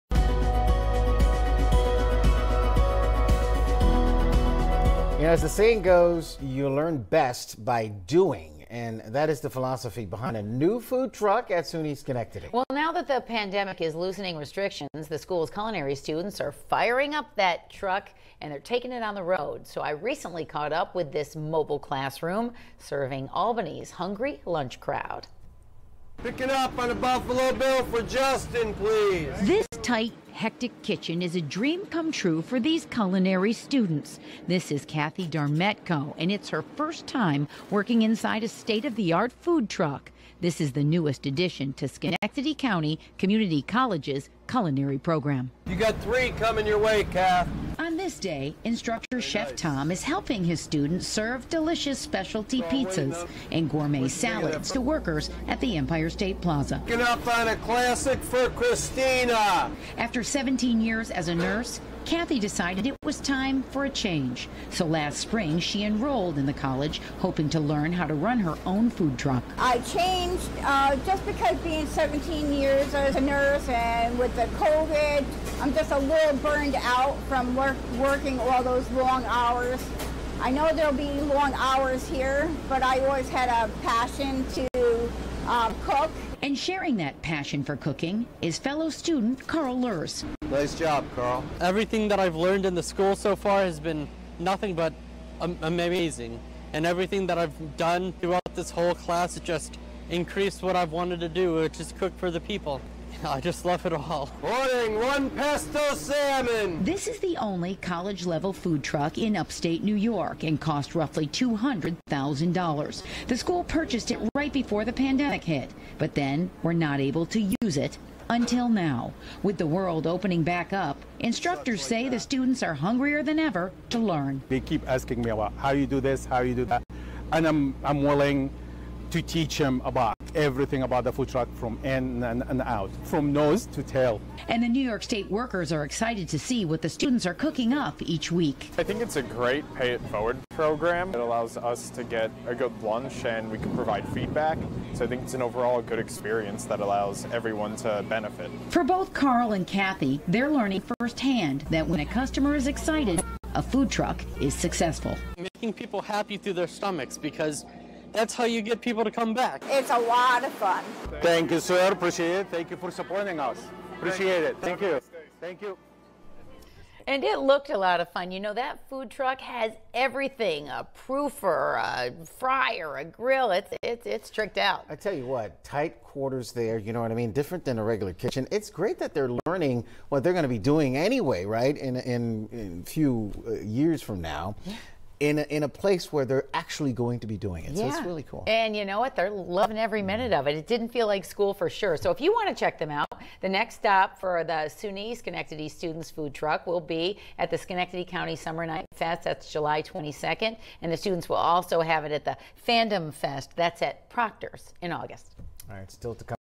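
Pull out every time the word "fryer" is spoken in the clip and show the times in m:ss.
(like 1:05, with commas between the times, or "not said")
2:52.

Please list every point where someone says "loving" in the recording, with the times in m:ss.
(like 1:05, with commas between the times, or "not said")
3:09.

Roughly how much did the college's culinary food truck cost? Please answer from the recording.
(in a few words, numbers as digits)
$200,000.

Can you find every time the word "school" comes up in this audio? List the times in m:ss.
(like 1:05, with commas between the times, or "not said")
0:15, 1:32, 1:53, 3:11.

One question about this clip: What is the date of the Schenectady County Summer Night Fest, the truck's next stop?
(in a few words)
July 22.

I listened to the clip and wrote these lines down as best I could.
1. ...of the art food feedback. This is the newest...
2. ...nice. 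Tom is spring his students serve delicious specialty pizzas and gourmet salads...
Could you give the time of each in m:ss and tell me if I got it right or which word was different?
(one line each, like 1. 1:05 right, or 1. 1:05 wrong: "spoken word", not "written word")
1. 0:38 wrong: "truck", not "feedback"
2. 0:49 wrong: "helping", not "spring".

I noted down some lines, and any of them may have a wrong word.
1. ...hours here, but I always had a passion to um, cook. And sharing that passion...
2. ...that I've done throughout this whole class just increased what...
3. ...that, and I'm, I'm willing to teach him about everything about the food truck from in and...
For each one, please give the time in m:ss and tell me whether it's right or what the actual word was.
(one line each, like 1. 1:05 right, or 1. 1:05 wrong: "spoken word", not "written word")
1. 1:21 right
2. 1:37 right
3. 2:06 right.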